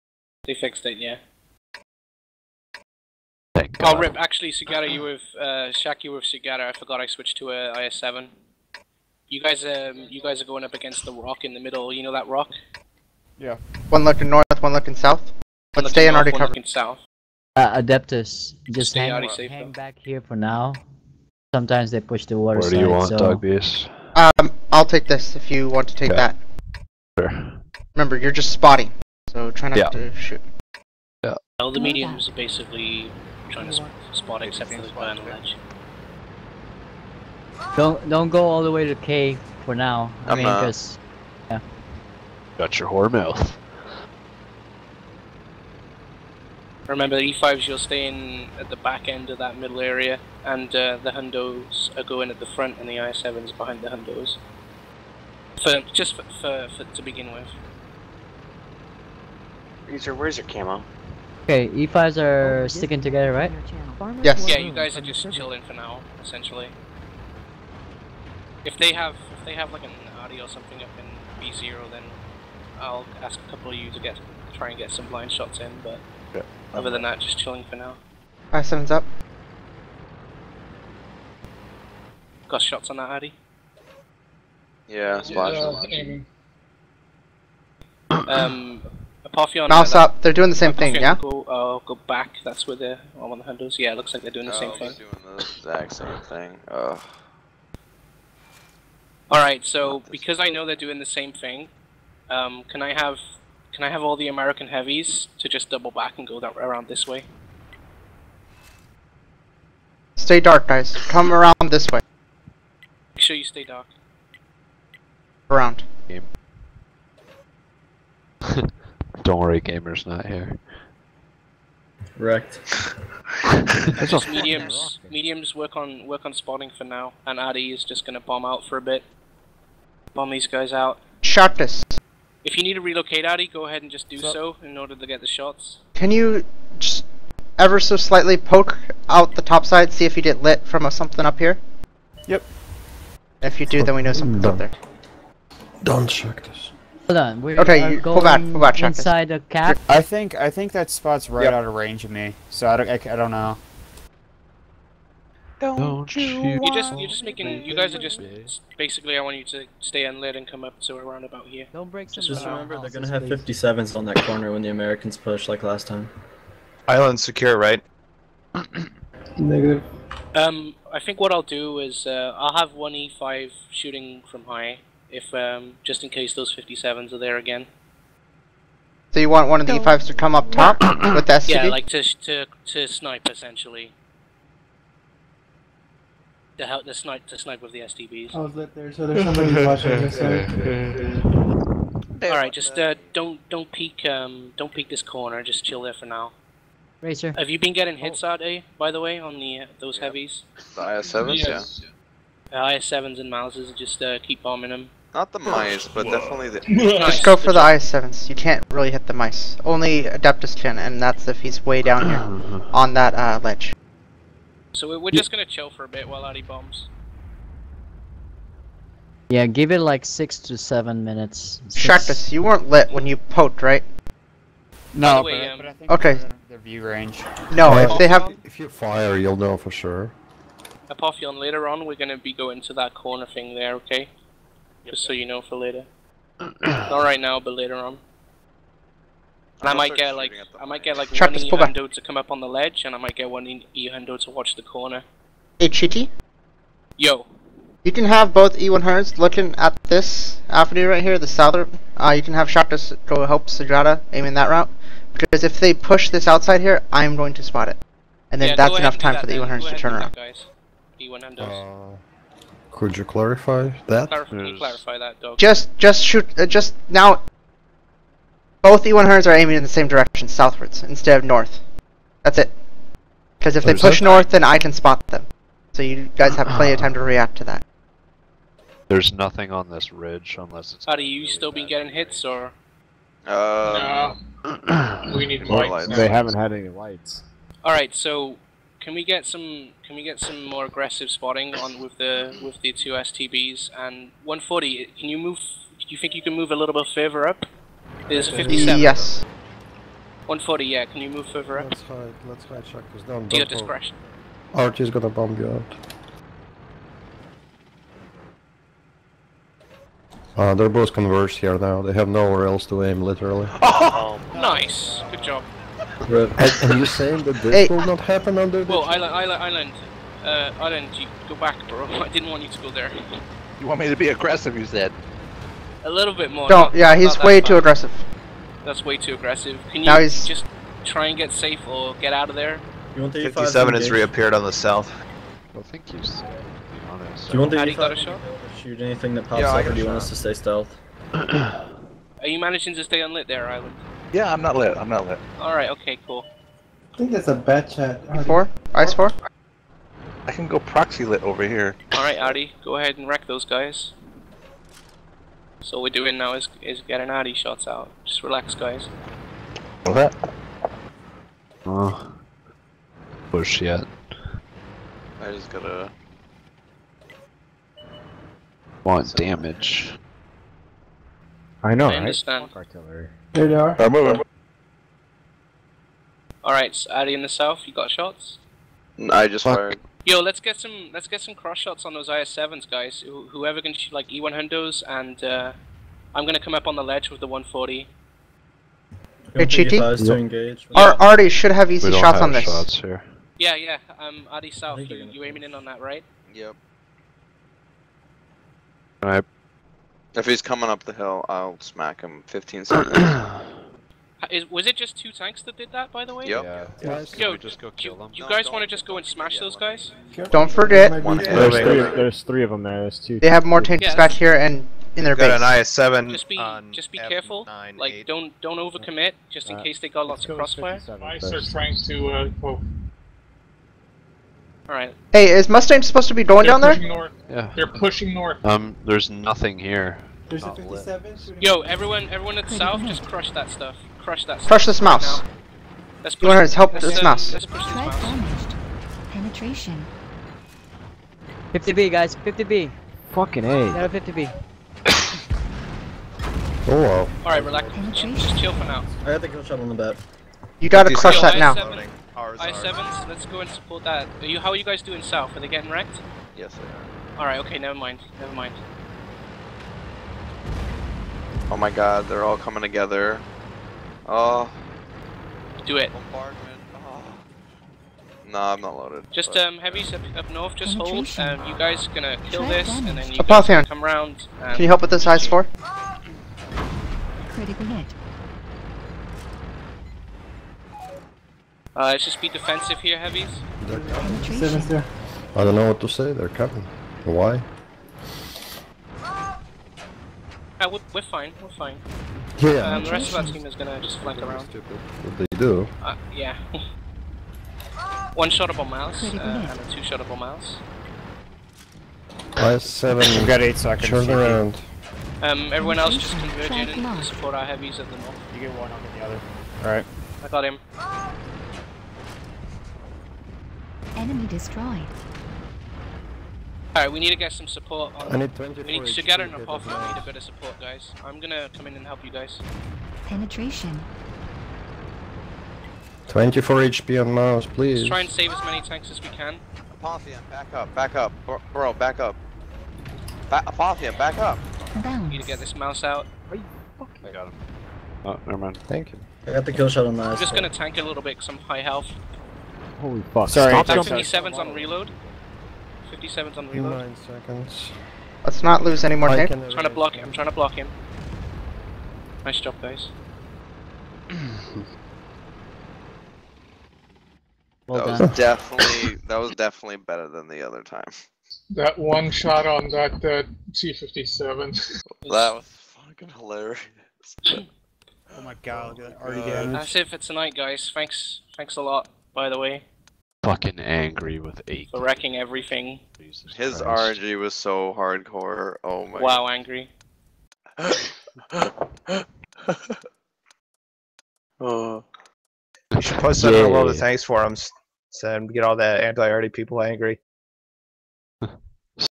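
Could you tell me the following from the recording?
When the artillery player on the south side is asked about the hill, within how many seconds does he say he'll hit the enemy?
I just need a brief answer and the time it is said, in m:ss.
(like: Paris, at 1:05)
15 seconds, at 6:42.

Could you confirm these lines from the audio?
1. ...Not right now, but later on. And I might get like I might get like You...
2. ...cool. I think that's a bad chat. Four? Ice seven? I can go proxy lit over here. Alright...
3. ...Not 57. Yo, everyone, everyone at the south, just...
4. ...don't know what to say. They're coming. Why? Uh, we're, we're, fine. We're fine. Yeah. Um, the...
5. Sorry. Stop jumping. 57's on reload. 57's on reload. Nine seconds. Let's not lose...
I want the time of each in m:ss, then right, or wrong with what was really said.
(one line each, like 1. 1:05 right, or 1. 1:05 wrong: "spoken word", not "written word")
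1. 3:56 wrong: "Trap", not "You"
2. 5:46 wrong: "four", not "seven"
3. 7:10 right
4. 8:05 right
5. 9:03 right.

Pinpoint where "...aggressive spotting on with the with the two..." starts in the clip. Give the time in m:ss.
4:50.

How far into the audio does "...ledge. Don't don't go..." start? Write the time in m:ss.
0:35.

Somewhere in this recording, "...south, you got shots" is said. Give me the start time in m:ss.
6:17.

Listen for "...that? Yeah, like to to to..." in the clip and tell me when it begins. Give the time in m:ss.
3:01.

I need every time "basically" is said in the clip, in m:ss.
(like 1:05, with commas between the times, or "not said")
0:32, 2:38.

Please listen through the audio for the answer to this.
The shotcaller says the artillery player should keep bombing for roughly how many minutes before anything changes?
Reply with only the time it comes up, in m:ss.
3:40.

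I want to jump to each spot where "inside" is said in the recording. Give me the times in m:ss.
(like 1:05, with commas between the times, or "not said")
2:28.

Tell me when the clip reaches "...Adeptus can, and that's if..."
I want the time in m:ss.
3:30.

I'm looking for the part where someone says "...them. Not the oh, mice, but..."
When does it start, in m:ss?
3:24.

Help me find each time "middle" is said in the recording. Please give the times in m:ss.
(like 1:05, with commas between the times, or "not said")
0:11, 0:49.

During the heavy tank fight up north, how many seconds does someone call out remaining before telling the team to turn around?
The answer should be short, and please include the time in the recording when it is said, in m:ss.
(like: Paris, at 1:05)
8 seconds, at 8:23.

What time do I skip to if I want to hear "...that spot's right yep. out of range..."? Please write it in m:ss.
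2:30.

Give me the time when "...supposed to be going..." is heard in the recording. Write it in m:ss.
7:05.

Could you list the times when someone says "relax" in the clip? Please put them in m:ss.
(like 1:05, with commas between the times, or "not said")
5:58, 7:27.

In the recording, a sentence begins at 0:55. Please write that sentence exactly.
For just for, for, for to begin with.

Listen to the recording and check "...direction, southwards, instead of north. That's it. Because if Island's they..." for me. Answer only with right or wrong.
wrong.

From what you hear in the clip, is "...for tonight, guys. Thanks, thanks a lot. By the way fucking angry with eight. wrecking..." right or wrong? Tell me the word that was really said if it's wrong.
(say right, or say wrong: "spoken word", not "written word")
right.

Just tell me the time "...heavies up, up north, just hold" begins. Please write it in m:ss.
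7:49.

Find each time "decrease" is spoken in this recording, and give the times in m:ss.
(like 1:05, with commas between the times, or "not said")
not said.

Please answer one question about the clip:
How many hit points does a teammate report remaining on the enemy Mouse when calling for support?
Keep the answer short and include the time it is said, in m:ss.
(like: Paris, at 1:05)
24, at 8:46.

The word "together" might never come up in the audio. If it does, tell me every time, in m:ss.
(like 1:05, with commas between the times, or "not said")
1:03, 7:42.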